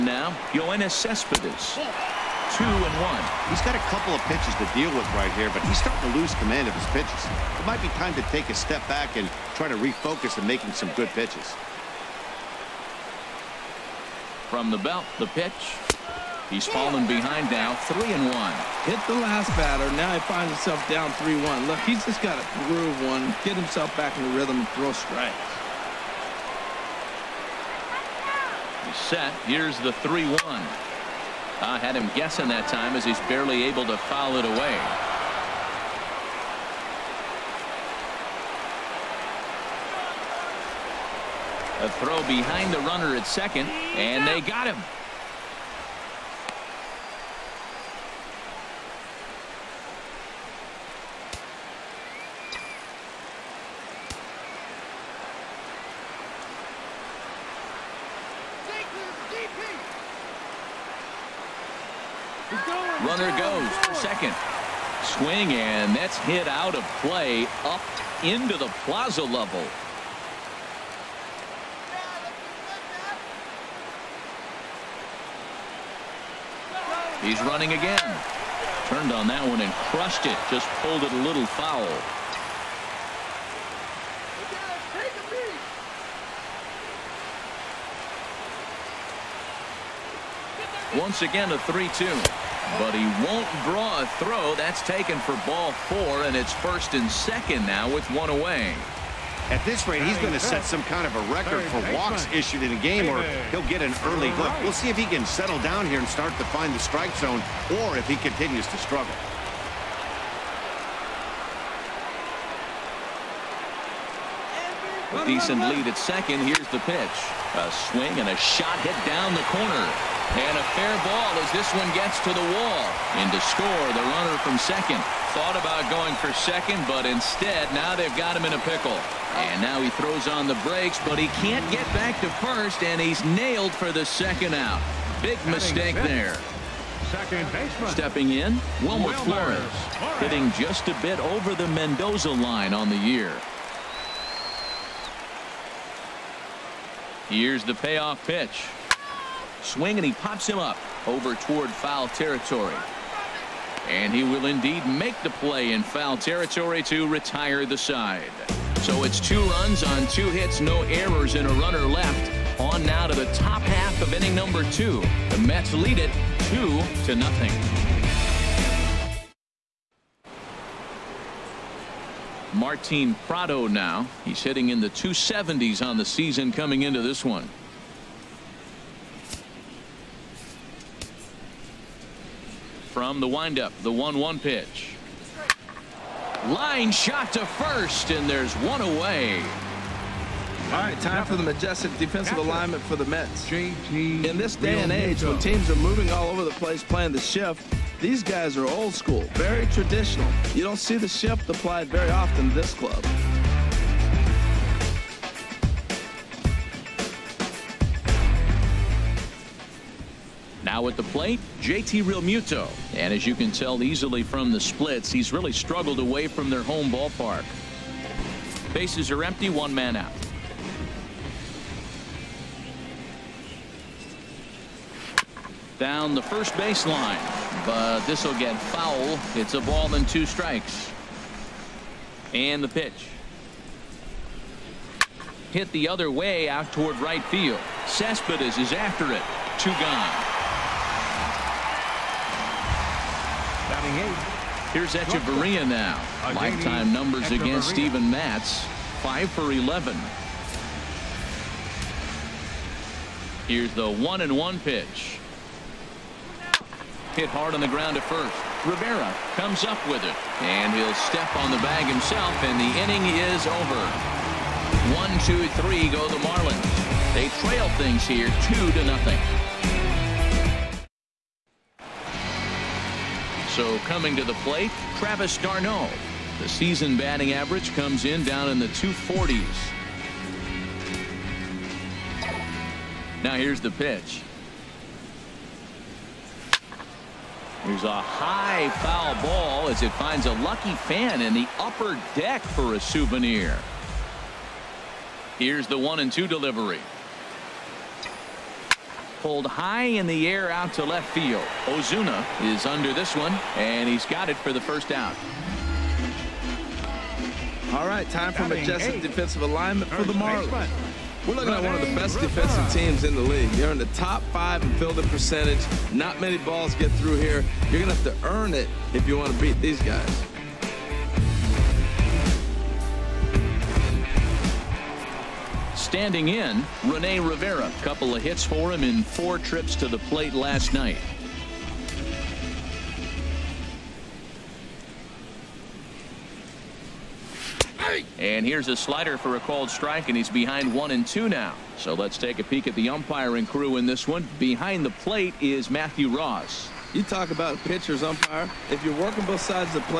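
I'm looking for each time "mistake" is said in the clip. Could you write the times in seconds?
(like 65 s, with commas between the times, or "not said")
135 s.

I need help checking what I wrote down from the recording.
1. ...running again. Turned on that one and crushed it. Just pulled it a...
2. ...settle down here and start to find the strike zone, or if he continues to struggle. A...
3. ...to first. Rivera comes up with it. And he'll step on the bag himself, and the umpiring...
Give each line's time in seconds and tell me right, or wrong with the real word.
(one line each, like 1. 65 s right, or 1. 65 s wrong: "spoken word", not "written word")
1. 77 s right
2. 105 s right
3. 257 s wrong: "inning", not "umpiring".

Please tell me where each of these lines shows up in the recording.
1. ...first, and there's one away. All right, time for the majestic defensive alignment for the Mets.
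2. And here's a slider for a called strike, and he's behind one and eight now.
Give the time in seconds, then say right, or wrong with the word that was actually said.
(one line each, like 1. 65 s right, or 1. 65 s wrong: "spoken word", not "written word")
1. 187 s right
2. 338 s wrong: "two", not "eight".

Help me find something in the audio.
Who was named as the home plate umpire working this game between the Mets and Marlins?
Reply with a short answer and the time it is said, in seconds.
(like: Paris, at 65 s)
Matthew Ross, at 345 s.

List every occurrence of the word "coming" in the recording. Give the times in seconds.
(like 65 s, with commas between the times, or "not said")
176 s, 273 s.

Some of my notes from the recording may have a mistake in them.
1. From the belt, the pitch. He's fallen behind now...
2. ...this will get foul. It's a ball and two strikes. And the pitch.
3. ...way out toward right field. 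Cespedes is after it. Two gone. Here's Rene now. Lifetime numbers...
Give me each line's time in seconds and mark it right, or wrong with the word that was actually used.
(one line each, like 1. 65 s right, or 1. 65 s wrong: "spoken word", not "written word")
1. 14 s right
2. 228 s right
3. 236 s wrong: "Hechavarria", not "Rene".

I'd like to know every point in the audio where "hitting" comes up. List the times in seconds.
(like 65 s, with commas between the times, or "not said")
140 s, 174 s.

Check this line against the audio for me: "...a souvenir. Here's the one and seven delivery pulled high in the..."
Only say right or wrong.
wrong.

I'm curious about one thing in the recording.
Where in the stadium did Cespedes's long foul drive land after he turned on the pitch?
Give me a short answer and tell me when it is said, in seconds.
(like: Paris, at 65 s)
plaza level, at 68 s.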